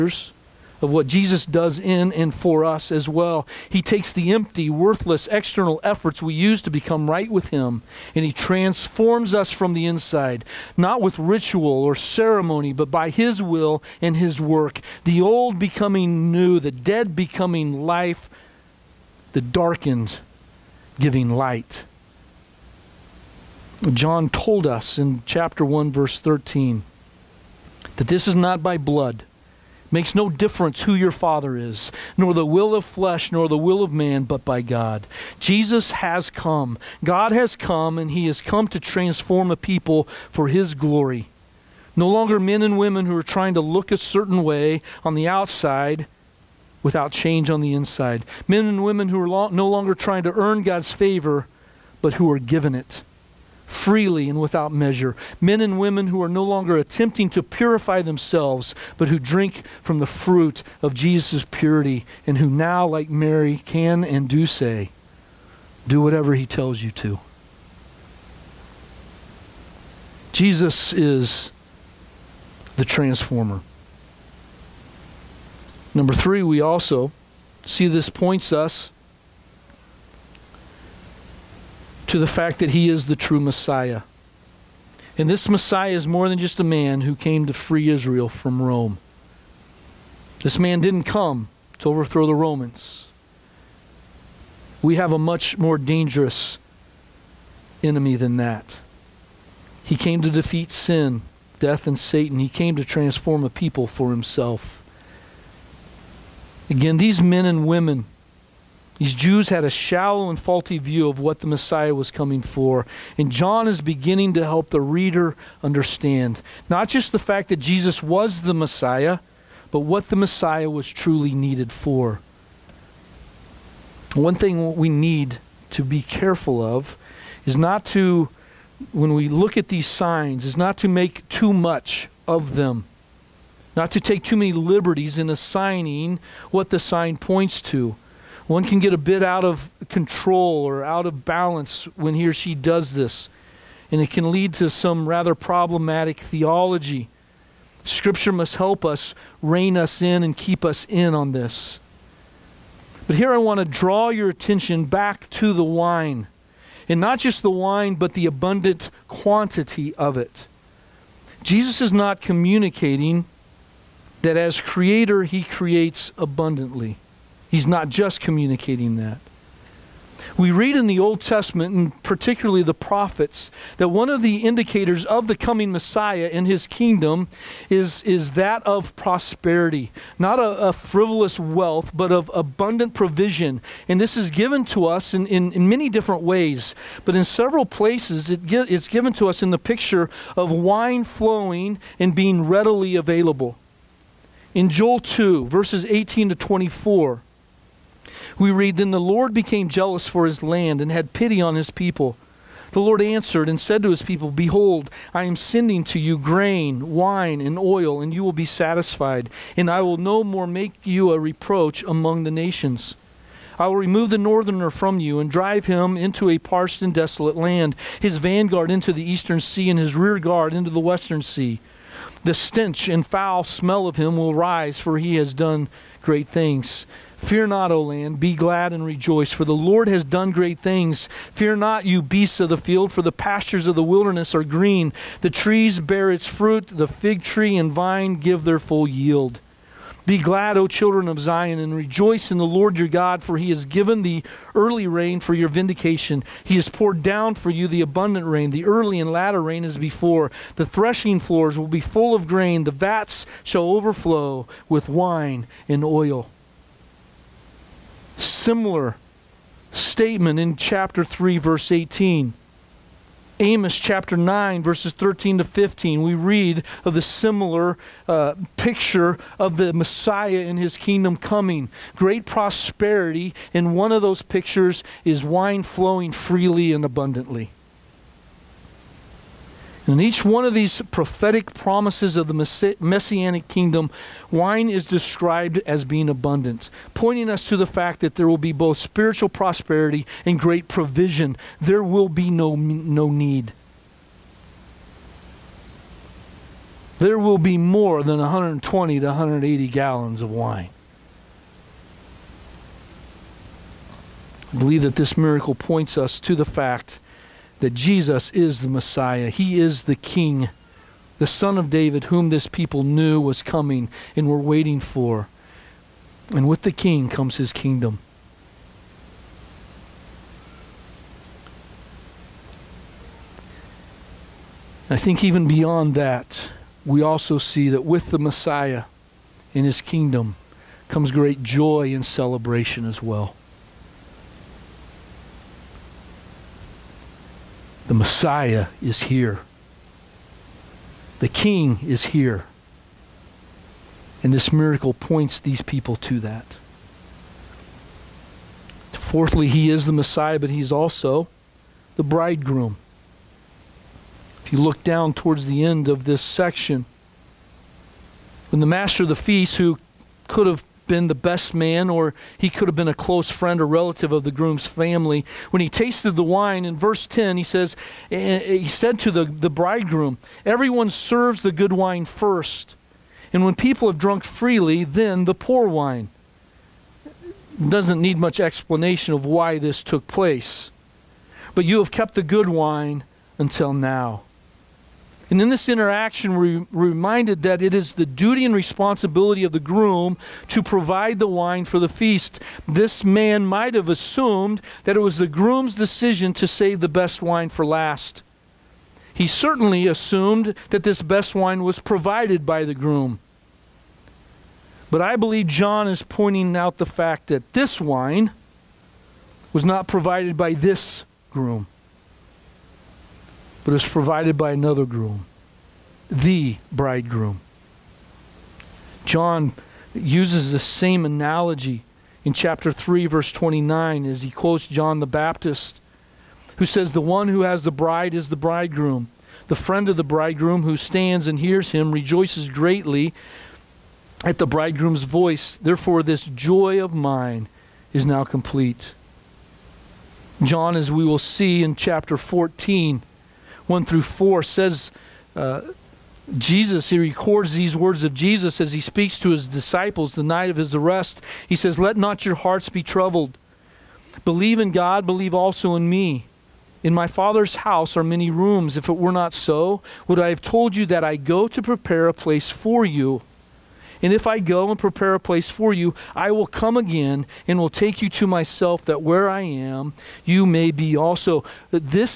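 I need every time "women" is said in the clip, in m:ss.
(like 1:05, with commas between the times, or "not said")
0:42, 0:48, 0:55, 1:47.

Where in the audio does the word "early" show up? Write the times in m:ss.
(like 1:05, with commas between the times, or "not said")
4:04, 4:08.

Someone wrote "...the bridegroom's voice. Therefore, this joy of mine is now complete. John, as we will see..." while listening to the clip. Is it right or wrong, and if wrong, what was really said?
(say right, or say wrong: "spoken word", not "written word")
right.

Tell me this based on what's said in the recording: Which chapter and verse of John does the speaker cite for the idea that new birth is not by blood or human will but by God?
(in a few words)
chapter 1, verse 13.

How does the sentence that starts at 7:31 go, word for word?
He says, Let not your hearts be troubled.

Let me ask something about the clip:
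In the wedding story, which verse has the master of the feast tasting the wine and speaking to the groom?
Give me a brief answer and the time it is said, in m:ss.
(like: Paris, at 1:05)
verse 10, at 6:06.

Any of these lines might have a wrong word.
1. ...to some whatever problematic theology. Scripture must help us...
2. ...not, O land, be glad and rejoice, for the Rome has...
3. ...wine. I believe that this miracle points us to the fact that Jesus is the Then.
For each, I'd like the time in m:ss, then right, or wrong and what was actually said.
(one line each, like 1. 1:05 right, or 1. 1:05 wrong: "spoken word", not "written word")
1. 2:24 wrong: "rather", not "whatever"
2. 3:47 wrong: "Lord", not "Rome"
3. 5:00 wrong: "Messiah", not "Then".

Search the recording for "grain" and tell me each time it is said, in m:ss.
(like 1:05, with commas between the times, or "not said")
3:26, 4:12.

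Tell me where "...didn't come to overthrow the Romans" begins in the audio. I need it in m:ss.
1:30.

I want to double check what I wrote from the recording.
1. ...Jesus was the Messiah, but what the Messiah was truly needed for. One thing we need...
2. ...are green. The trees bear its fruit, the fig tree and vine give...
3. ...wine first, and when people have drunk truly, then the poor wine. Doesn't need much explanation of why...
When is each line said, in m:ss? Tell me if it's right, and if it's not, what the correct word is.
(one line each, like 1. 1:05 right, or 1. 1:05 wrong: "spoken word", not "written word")
1. 1:57 right
2. 3:54 right
3. 6:11 wrong: "freely", not "truly".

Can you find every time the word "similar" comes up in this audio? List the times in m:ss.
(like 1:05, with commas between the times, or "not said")
4:18, 4:27.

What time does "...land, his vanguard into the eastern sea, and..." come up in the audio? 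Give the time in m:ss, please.
3:37.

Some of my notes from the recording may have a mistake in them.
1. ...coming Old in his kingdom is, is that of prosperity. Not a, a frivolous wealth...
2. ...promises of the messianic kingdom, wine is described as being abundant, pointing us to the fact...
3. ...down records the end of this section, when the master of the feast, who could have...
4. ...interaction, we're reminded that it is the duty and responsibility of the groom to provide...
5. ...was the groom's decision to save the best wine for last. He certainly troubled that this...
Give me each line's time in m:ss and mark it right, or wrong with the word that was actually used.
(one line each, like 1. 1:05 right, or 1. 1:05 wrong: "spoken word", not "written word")
1. 2:55 wrong: "Messiah", not "Old"
2. 4:41 right
3. 5:54 wrong: "towards", not "records"
4. 6:25 right
5. 6:35 wrong: "assumed", not "troubled".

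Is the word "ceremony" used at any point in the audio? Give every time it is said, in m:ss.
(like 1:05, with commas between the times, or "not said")
0:11.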